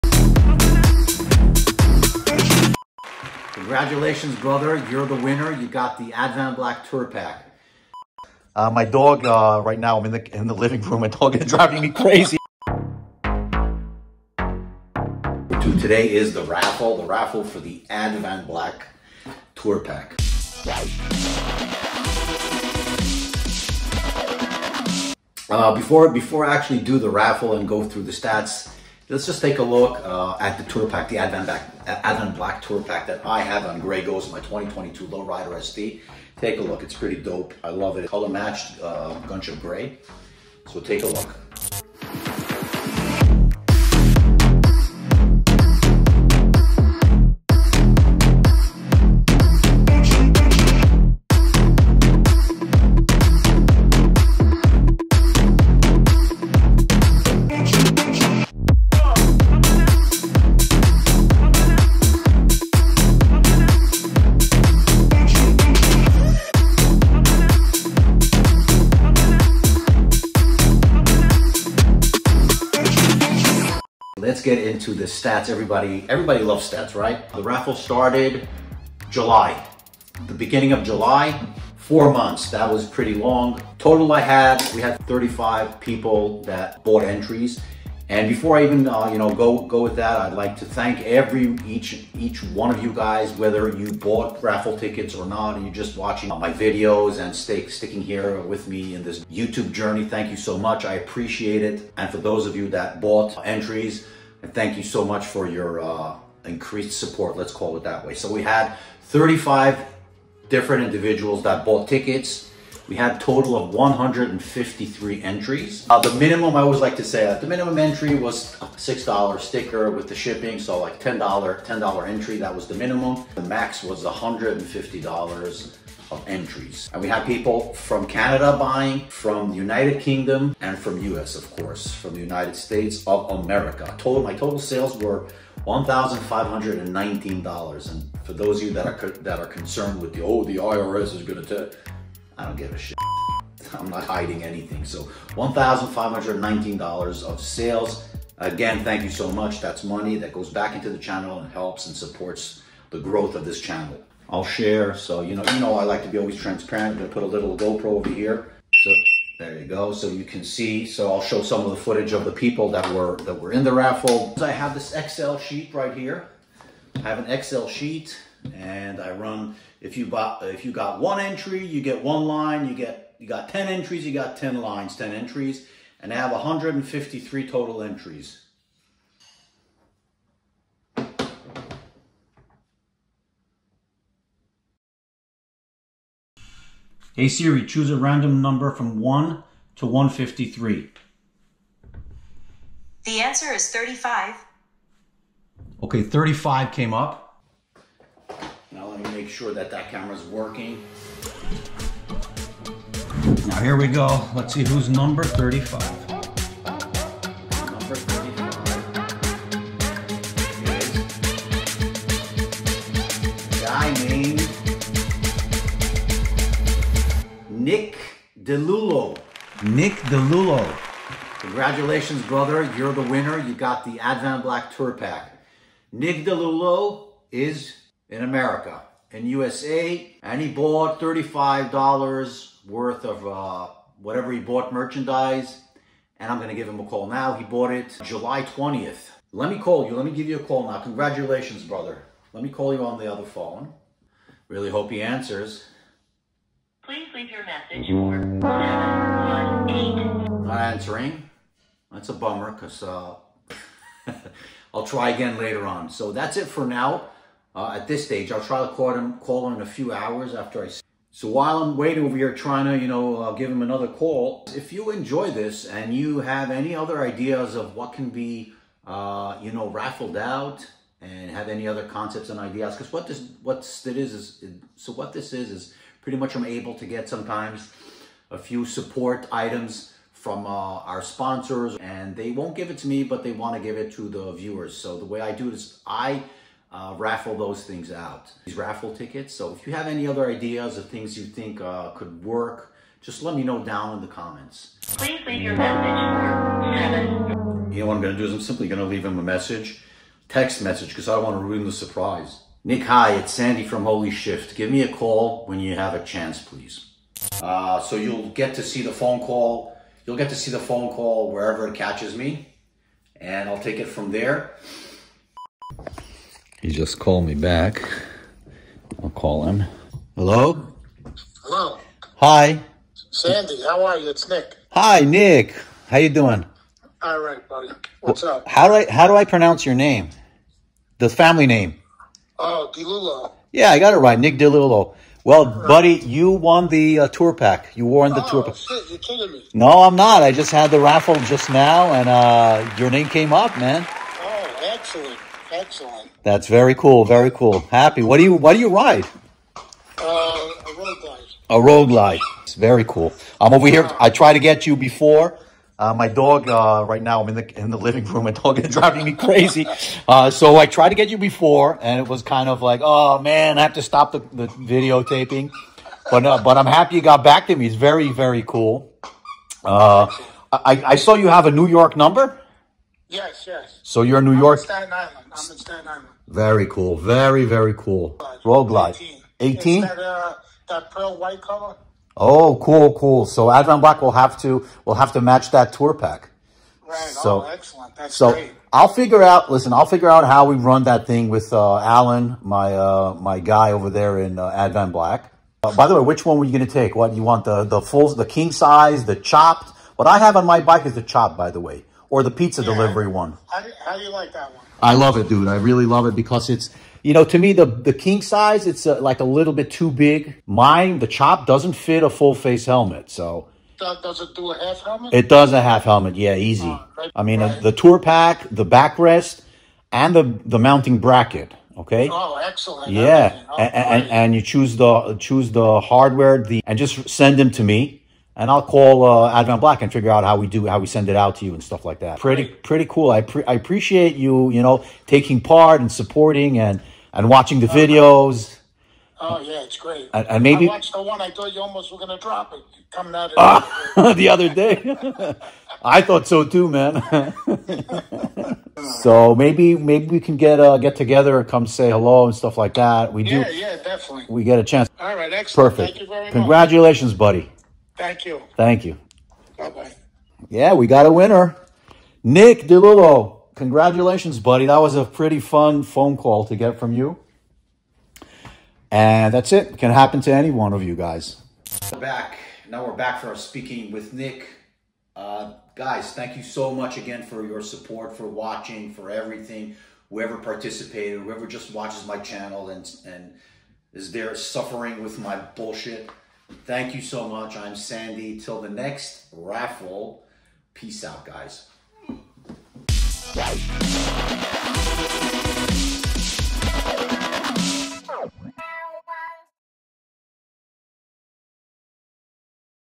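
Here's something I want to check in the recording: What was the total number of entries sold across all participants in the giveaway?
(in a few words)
153.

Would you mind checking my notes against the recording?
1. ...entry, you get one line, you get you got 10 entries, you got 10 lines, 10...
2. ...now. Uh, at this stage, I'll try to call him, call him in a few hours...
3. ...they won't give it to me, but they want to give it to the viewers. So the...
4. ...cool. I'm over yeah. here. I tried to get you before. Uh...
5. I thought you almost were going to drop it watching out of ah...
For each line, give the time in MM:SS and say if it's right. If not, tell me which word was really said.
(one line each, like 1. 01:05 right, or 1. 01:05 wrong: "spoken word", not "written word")
1. 02:51 right
2. 04:16 right
3. 04:42 right
4. 05:52 right
5. 07:21 wrong: "coming", not "watching".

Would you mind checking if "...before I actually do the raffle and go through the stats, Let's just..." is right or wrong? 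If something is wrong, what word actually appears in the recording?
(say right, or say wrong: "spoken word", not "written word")
right.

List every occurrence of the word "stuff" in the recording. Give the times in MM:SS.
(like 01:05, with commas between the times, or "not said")
07:11, 07:32.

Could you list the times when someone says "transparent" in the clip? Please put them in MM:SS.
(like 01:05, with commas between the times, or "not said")
02:36.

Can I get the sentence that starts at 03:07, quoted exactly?
Hey Siri, choose a random number from 1 to 153.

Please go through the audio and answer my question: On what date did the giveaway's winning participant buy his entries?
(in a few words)
July 20.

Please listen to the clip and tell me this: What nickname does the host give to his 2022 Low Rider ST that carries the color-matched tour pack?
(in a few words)
Grey Ghost.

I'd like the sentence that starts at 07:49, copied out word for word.
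can happen to any one of you guys.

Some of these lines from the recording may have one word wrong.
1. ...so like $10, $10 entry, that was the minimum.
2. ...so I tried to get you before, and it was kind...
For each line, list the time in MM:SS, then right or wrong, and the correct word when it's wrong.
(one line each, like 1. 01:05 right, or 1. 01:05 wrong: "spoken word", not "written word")
1. 02:00 right
2. 06:00 right.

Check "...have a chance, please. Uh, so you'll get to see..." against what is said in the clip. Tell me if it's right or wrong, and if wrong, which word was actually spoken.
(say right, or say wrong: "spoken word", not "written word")
right.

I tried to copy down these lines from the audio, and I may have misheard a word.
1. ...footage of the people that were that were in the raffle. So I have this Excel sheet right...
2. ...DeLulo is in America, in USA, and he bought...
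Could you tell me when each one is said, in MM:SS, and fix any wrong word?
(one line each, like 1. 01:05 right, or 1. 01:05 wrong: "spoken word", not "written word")
1. 02:41 right
2. 03:46 right.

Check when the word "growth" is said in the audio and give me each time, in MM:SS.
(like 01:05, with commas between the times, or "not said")
02:32.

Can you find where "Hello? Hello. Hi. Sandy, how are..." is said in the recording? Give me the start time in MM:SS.
05:20.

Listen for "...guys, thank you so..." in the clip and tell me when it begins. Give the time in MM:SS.
07:55.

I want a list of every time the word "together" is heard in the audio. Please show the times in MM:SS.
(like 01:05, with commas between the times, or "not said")
07:30.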